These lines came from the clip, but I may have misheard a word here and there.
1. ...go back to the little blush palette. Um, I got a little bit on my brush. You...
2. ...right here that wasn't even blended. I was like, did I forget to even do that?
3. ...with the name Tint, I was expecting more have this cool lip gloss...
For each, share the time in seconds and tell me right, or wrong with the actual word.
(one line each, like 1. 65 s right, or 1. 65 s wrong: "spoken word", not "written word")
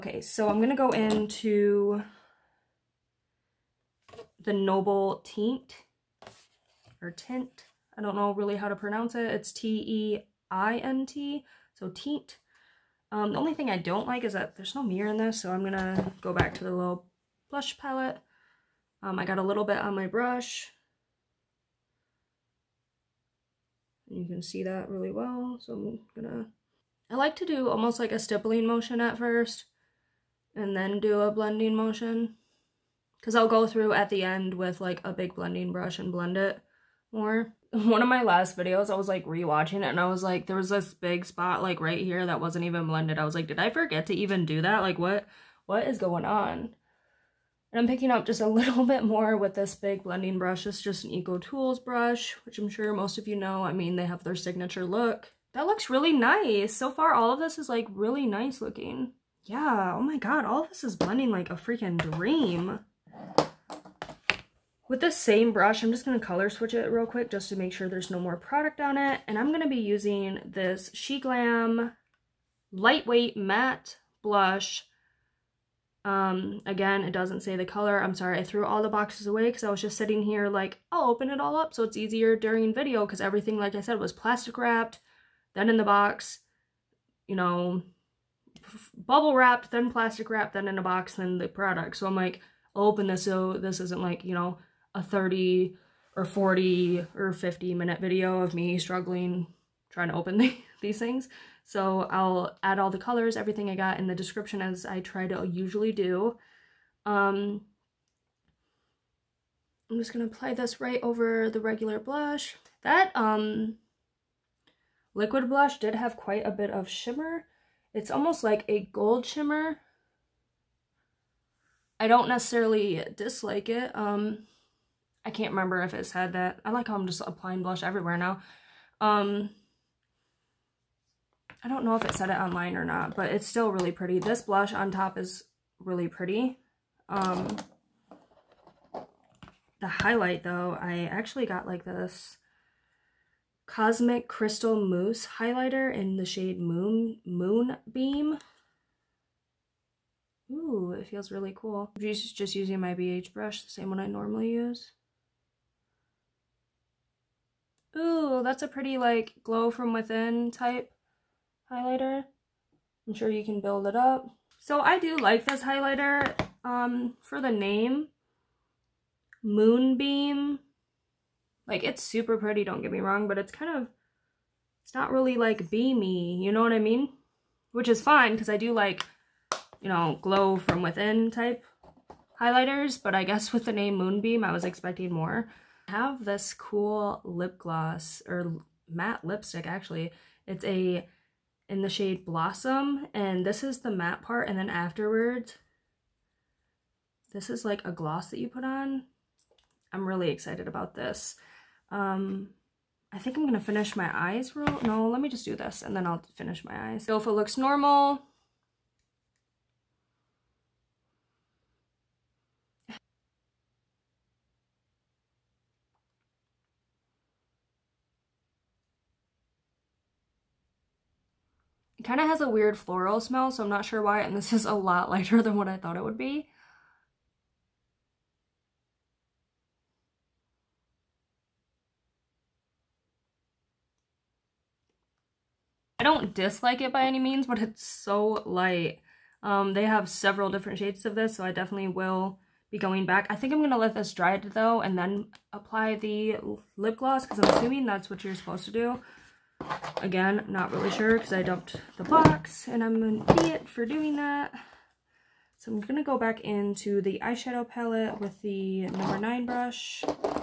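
1. 16 s right
2. 41 s right
3. 183 s wrong: "Moonbeam", not "Tint".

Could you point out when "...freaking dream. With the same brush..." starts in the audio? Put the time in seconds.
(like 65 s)
61 s.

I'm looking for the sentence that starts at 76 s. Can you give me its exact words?
Um, again, it doesn't say the color.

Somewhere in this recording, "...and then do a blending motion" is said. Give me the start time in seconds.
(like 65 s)
30 s.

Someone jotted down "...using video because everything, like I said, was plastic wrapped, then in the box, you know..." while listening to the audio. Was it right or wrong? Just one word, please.
wrong.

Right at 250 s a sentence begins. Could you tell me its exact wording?
Again, not really sure because I dumped the box and I'm an idiot for doing that.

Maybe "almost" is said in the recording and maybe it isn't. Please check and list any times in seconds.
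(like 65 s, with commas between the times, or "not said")
27 s, 118 s.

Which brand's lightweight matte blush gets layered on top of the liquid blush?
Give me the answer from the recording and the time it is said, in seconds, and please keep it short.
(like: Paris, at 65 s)
SheGlam, at 70 s.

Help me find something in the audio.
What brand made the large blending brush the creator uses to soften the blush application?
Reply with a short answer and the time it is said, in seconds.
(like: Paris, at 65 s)
EcoTools, at 51 s.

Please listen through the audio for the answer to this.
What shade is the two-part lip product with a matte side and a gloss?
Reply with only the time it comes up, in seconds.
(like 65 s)
192 s.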